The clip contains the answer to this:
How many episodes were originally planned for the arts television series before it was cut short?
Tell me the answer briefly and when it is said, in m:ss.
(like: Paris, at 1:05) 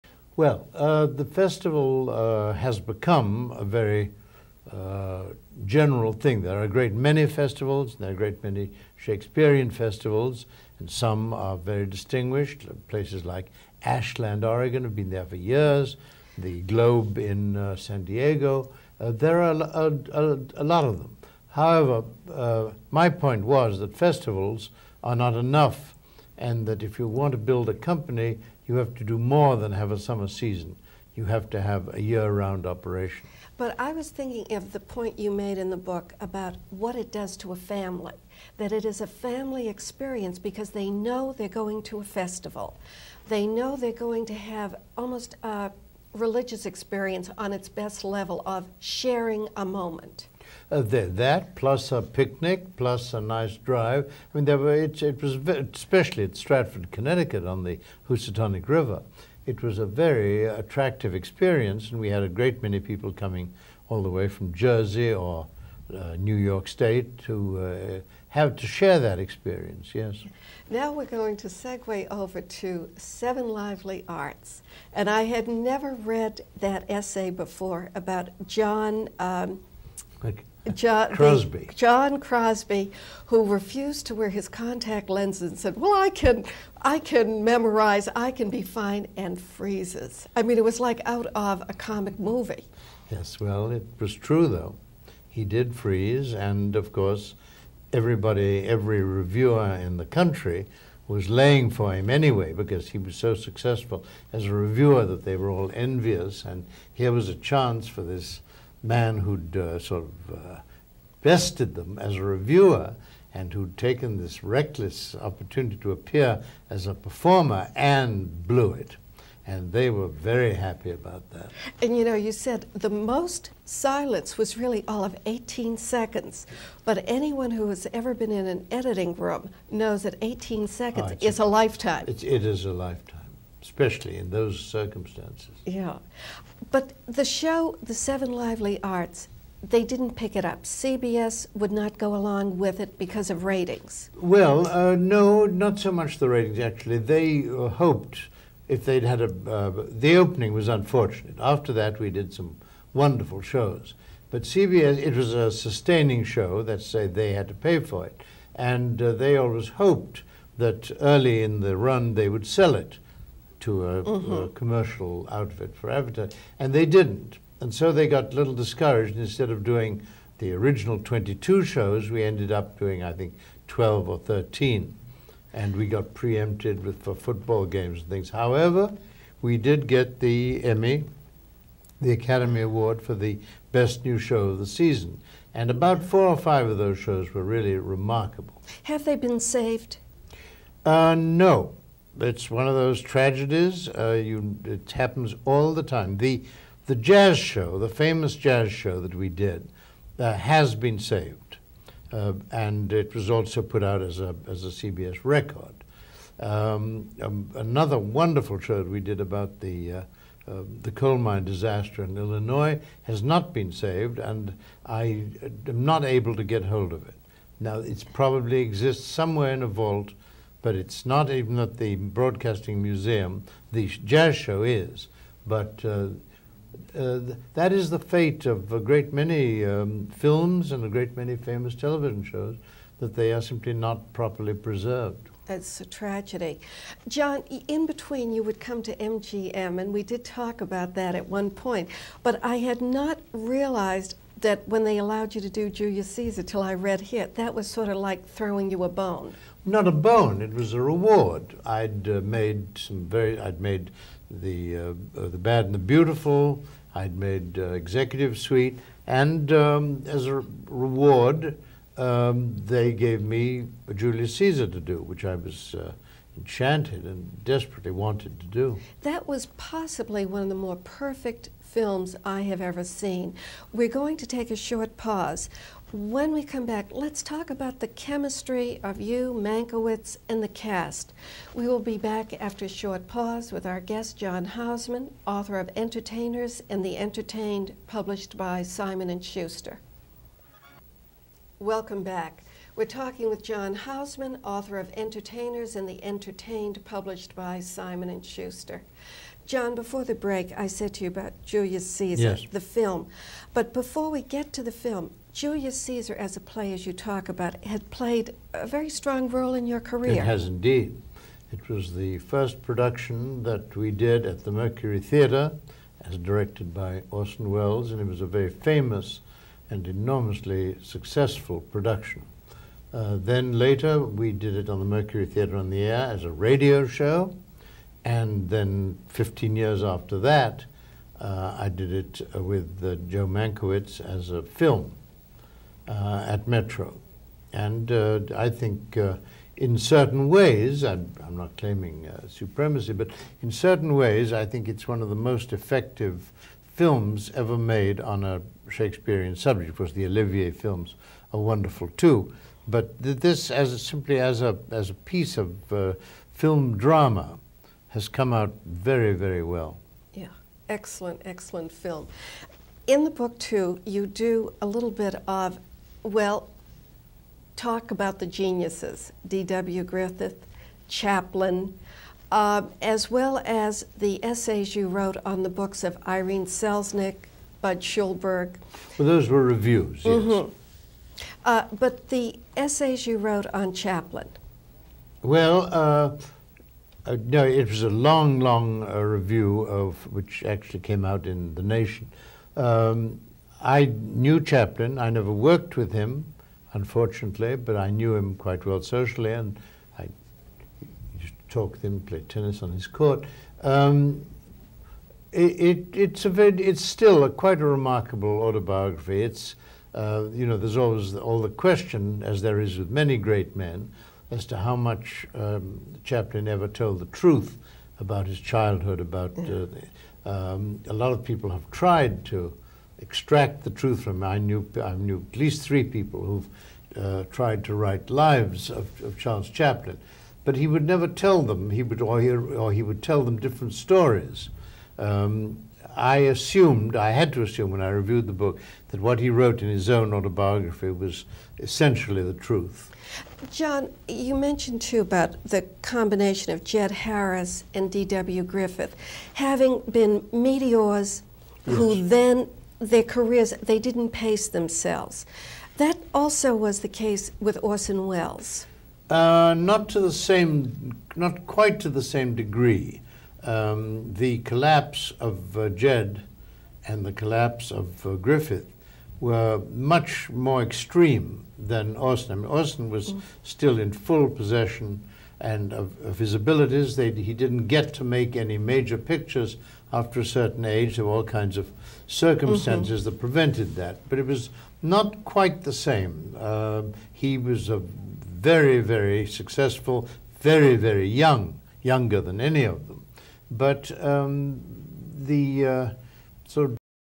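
22, at 2:51.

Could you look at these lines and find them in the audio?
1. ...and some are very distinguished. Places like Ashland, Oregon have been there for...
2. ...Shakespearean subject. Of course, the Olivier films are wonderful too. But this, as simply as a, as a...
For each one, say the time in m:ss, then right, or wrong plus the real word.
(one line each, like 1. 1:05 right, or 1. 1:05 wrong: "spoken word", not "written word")
1. 0:10 right
2. 5:48 right.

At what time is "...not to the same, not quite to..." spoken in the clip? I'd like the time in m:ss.
7:39.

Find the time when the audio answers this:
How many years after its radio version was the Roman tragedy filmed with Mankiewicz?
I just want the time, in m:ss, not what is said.
5:29.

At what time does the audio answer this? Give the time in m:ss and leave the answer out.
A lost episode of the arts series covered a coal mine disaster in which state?
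3:32.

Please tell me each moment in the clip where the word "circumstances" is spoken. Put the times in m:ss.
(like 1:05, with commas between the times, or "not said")
2:14, 8:02.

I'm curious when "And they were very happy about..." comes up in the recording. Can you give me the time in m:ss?
1:59.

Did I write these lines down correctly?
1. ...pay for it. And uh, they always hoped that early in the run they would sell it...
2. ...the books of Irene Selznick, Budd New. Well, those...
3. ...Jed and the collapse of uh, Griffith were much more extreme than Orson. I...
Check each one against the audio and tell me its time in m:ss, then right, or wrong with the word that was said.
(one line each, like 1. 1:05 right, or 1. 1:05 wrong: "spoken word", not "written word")
1. 2:37 right
2. 6:15 wrong: "Schulberg", not "New"
3. 7:45 right.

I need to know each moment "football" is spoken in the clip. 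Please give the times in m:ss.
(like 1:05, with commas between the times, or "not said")
2:57.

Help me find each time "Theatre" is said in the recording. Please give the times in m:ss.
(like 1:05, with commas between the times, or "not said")
5:15, 5:25.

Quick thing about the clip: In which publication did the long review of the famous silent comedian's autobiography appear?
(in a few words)
The Nation.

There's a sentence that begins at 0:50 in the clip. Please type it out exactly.
Uh, that plus a picnic, plus a nice drive.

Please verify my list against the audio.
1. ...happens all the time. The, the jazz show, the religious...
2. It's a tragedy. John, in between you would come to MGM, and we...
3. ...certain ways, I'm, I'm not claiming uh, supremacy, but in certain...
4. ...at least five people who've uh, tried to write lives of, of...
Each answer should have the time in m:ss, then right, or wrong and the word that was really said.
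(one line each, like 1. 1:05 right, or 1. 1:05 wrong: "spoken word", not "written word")
1. 3:14 wrong: "famous", not "religious"
2. 3:55 right
3. 5:39 right
4. 7:05 wrong: "three", not "five".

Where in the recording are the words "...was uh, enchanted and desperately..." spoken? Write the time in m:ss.
4:25.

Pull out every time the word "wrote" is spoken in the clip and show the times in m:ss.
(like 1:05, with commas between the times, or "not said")
6:14, 6:23, 7:19.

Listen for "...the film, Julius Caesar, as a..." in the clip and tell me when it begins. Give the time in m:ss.
5:04.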